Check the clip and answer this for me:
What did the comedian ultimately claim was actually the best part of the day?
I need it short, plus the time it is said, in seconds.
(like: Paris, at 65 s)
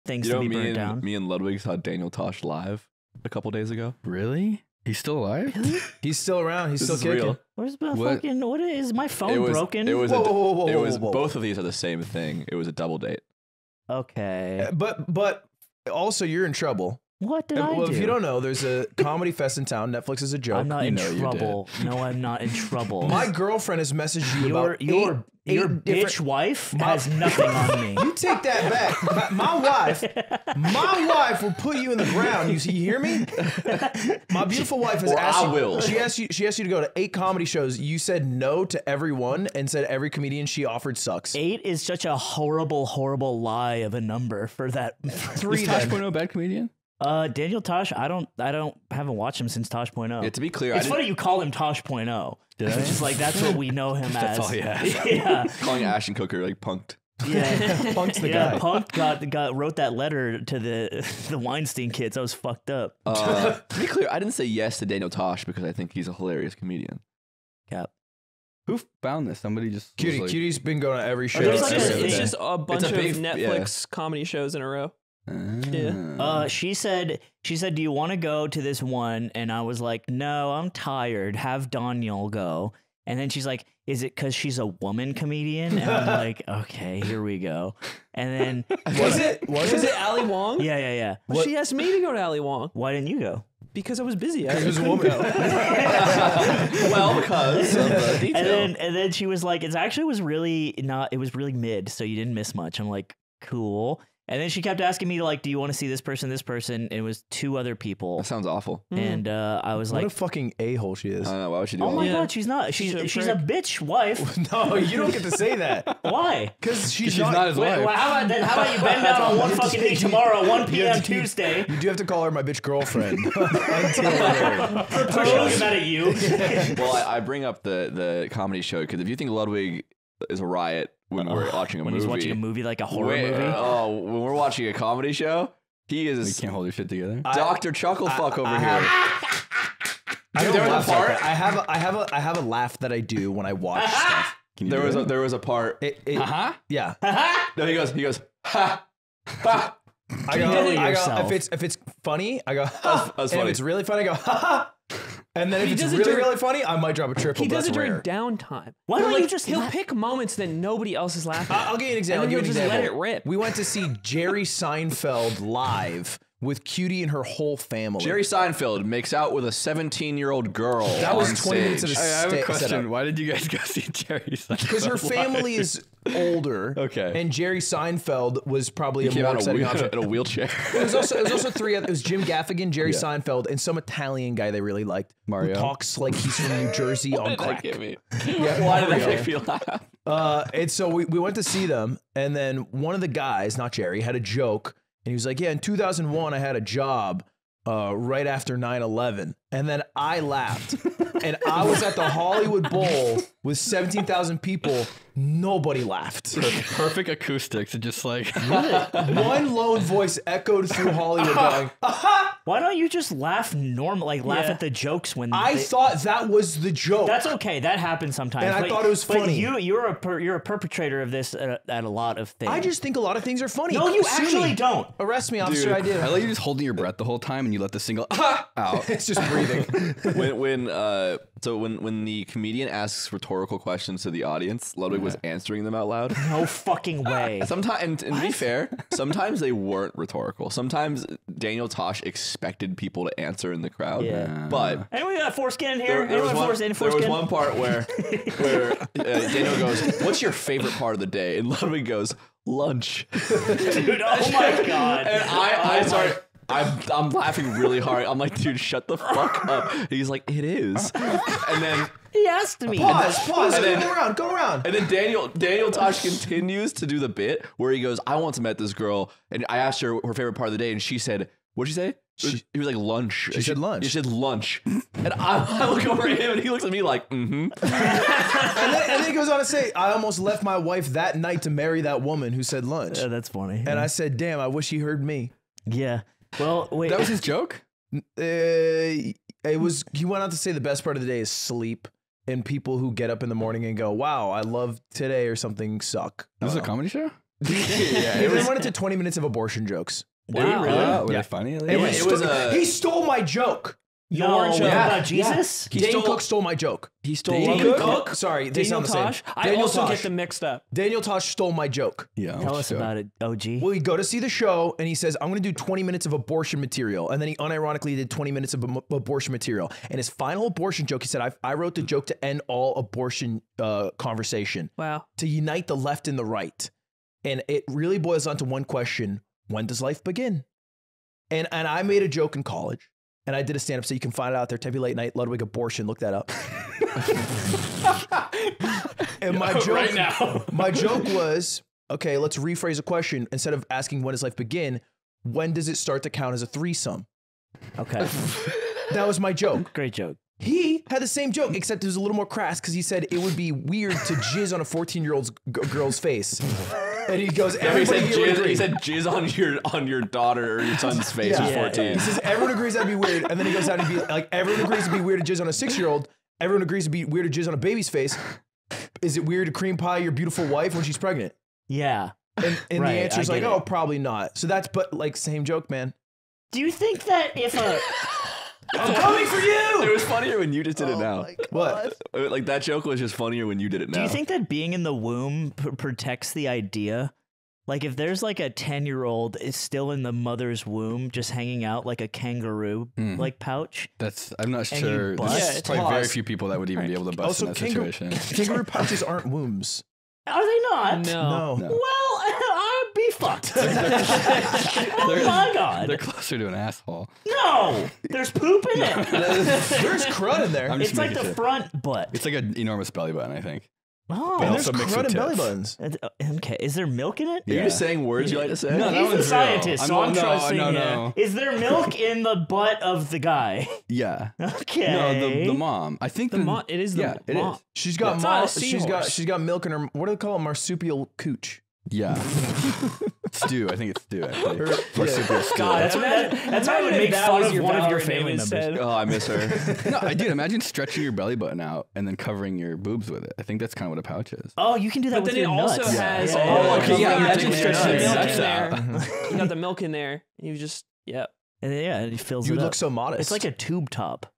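Sleep, at 291 s.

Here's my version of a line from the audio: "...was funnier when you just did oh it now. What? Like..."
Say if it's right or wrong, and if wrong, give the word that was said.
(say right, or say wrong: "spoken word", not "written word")
right.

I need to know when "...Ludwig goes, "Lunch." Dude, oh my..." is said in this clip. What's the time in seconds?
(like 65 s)
251 s.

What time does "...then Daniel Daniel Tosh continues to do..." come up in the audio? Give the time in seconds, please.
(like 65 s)
264 s.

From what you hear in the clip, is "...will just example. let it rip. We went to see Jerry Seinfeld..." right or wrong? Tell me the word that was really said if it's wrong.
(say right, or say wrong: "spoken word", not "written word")
right.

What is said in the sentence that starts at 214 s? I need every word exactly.
at the jokes when I they- thought that was the joke.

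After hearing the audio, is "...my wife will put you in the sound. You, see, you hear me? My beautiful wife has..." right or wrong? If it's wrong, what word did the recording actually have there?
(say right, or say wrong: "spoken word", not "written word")
wrong: "ground", not "sound".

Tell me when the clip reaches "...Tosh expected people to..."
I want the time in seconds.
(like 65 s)
241 s.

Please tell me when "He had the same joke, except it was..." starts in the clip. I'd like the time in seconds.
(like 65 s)
350 s.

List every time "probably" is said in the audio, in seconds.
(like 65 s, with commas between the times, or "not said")
178 s, 373 s, 395 s.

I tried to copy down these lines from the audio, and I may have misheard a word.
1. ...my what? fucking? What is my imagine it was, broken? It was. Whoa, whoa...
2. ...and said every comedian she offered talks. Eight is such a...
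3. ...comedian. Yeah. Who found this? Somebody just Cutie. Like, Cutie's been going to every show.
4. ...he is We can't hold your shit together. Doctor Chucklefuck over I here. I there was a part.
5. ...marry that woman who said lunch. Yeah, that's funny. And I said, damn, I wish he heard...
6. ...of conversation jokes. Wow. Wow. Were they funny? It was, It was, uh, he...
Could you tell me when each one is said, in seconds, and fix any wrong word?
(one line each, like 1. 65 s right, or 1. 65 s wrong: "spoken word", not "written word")
1. 7 s wrong: "phone", not "imagine"
2. 39 s wrong: "sucks", not "talks"
3. 66 s right
4. 135 s right
5. 281 s right
6. 299 s wrong: "abortion", not "conversation".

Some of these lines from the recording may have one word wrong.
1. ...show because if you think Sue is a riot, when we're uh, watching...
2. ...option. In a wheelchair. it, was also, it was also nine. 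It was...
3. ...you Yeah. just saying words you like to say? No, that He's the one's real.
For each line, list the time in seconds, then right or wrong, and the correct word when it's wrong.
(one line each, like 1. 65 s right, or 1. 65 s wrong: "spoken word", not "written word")
1. 128 s wrong: "Ludwig", not "Sue"
2. 179 s wrong: "three", not "nine"
3. 417 s right.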